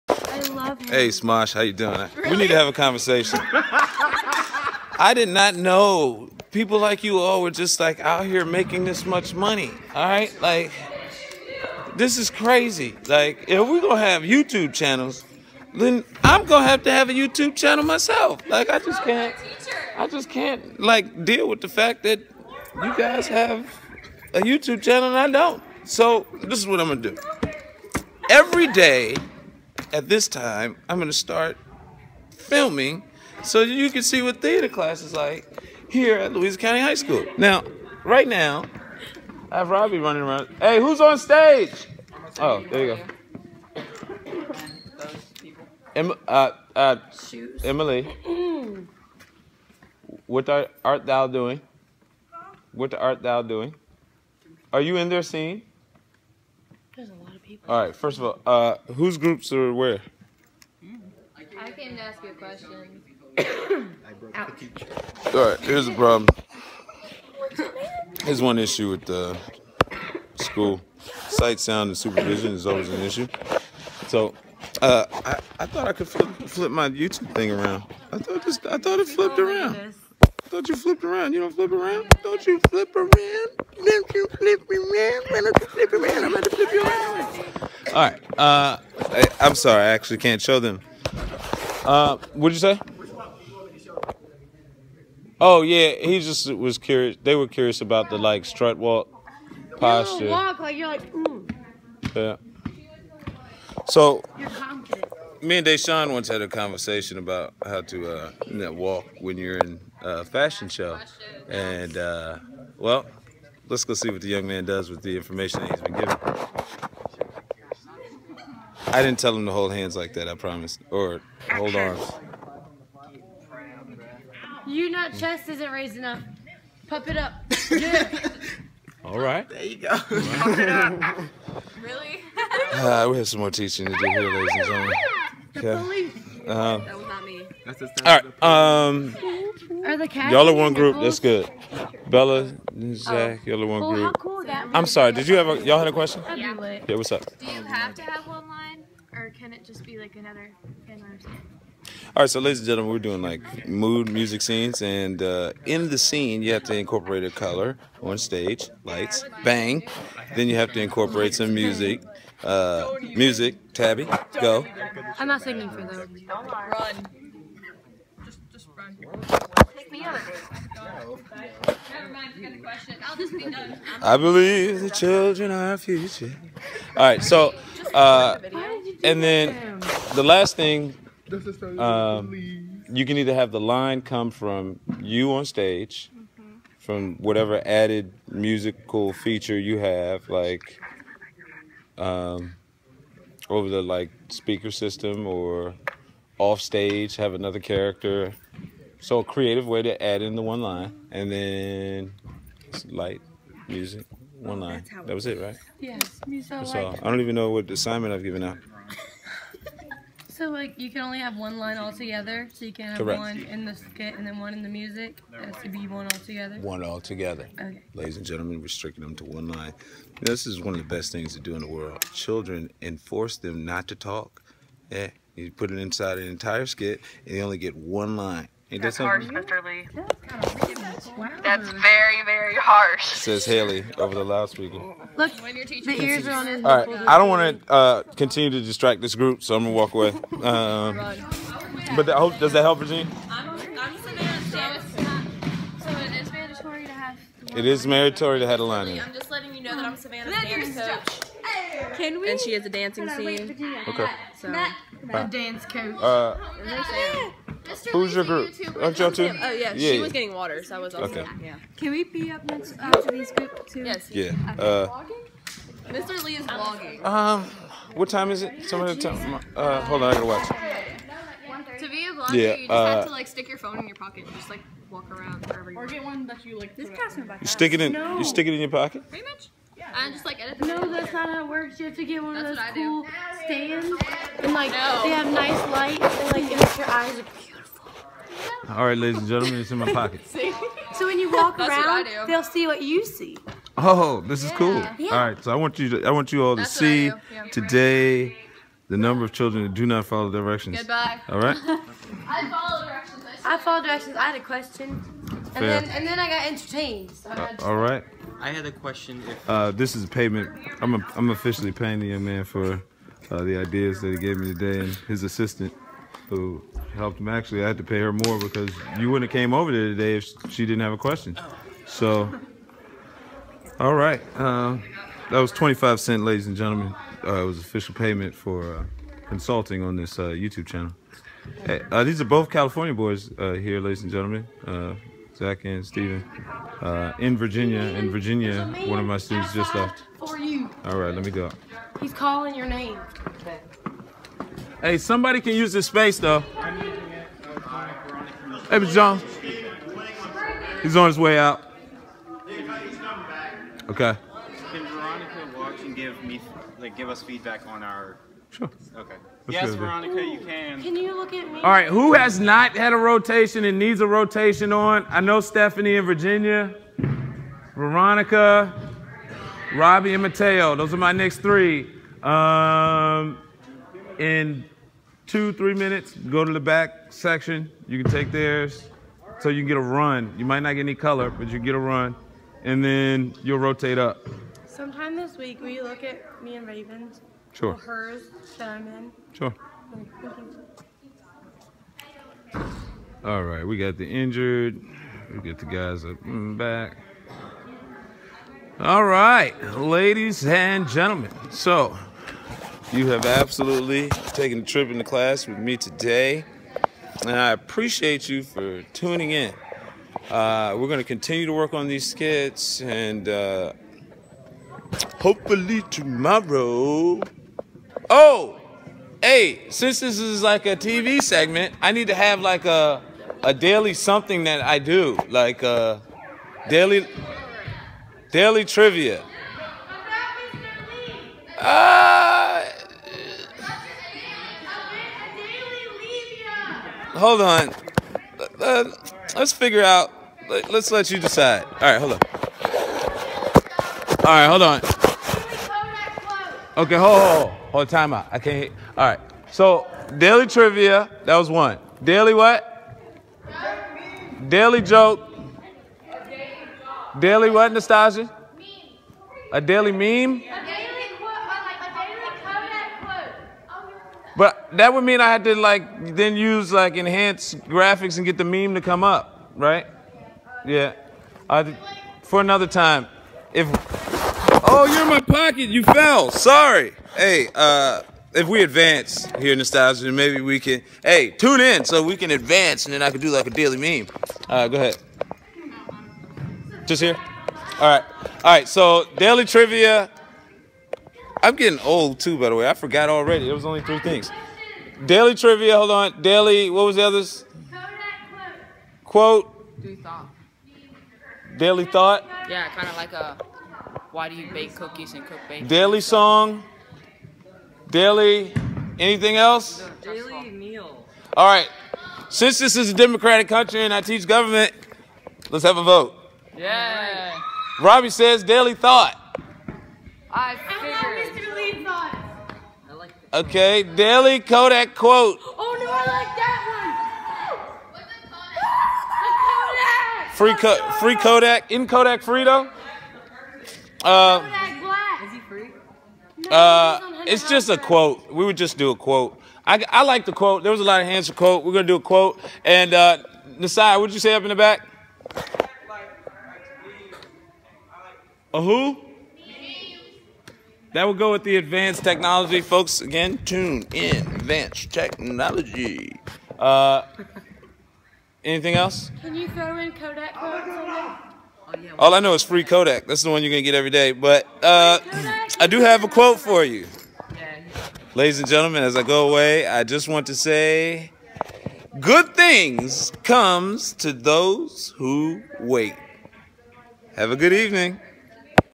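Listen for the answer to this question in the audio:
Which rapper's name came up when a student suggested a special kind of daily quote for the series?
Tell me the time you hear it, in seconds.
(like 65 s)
534 s.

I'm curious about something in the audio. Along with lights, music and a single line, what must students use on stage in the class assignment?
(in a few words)
A color.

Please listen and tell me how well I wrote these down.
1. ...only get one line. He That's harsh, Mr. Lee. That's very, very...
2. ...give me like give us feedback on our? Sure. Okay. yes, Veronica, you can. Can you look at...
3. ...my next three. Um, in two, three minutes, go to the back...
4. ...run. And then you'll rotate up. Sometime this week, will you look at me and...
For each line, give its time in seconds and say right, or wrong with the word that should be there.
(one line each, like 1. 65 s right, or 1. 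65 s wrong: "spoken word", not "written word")
1. 227 s right
2. 355 s right
3. 370 s right
4. 381 s right.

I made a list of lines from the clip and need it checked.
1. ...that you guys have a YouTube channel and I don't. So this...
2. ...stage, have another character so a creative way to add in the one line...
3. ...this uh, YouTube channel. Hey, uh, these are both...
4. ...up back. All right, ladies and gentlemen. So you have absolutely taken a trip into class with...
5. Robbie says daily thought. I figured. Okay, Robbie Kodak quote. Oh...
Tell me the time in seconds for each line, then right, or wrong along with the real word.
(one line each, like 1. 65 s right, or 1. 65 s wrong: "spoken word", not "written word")
1. 22 s right
2. 196 s right
3. 329 s right
4. 396 s right
5. 517 s wrong: "Daily", not "Robbie".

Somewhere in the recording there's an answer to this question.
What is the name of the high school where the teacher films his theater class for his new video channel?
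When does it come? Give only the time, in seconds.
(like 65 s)
36 s.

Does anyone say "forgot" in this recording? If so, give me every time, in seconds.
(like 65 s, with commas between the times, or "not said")
492 s.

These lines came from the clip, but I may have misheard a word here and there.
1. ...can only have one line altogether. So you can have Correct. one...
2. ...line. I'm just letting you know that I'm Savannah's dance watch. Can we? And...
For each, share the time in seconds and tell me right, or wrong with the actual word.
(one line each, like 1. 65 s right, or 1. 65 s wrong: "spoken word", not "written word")
1. 210 s right
2. 248 s wrong: "coach", not "watch".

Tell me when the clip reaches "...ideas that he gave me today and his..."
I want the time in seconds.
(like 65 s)
313 s.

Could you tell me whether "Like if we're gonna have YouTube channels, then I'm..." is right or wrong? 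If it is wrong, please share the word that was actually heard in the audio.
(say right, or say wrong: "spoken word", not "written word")
right.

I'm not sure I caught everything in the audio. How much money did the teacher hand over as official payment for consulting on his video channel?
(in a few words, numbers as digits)
25 cents.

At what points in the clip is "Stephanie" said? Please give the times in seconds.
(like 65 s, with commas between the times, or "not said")
365 s.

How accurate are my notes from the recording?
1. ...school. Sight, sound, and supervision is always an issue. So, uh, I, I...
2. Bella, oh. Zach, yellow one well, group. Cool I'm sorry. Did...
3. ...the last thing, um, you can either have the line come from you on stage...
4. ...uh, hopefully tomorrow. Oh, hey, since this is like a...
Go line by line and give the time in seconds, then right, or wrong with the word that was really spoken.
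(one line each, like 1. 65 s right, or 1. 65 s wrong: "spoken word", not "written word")
1. 70 s right
2. 142 s right
3. 180 s right
4. 413 s right.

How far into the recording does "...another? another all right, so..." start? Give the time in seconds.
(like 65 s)
150 s.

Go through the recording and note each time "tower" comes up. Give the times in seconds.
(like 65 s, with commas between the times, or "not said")
not said.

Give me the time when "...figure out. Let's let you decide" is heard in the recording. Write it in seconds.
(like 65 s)
439 s.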